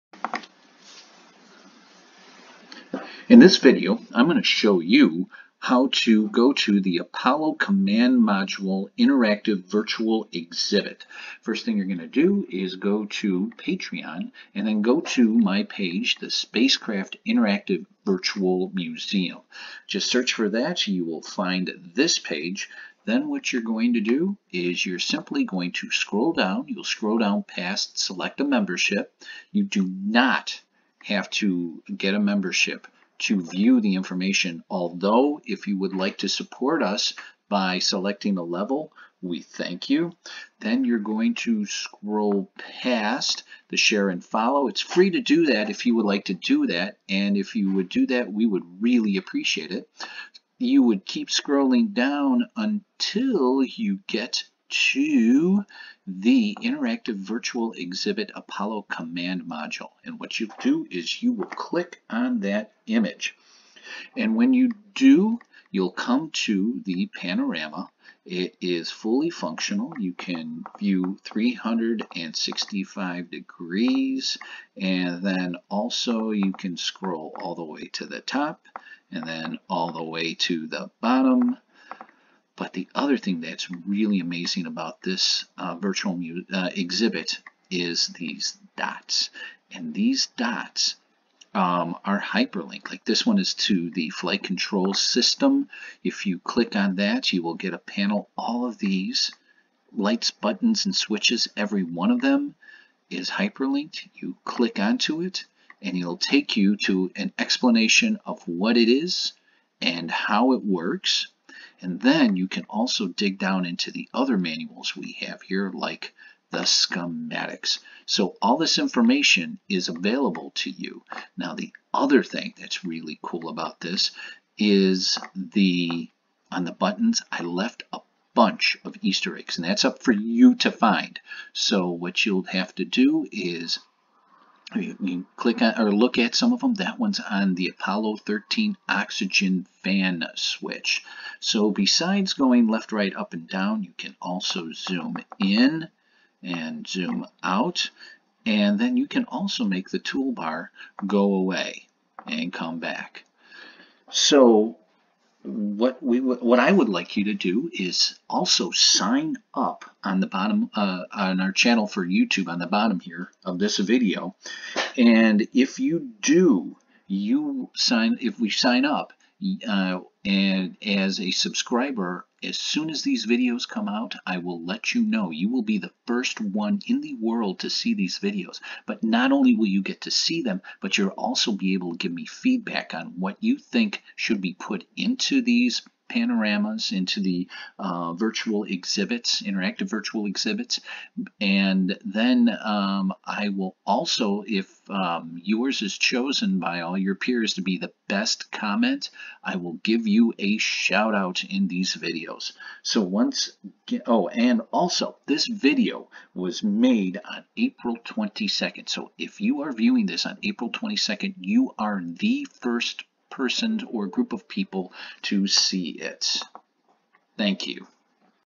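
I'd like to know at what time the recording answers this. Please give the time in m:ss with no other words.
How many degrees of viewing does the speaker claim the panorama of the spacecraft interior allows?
1:11.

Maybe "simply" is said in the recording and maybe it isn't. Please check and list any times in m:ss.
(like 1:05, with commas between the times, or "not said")
0:24.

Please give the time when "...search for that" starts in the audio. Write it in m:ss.
0:20.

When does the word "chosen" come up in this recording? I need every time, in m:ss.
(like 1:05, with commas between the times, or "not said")
3:15.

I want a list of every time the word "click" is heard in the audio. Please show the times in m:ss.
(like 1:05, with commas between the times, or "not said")
1:01, 1:36, 1:44, 2:15.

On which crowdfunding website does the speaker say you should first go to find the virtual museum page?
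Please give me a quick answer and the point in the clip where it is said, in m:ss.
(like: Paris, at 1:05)
Patreon, at 0:13.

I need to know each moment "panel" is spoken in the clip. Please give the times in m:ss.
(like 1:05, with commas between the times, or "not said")
1:37.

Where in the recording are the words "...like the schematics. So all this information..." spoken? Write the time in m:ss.
1:55.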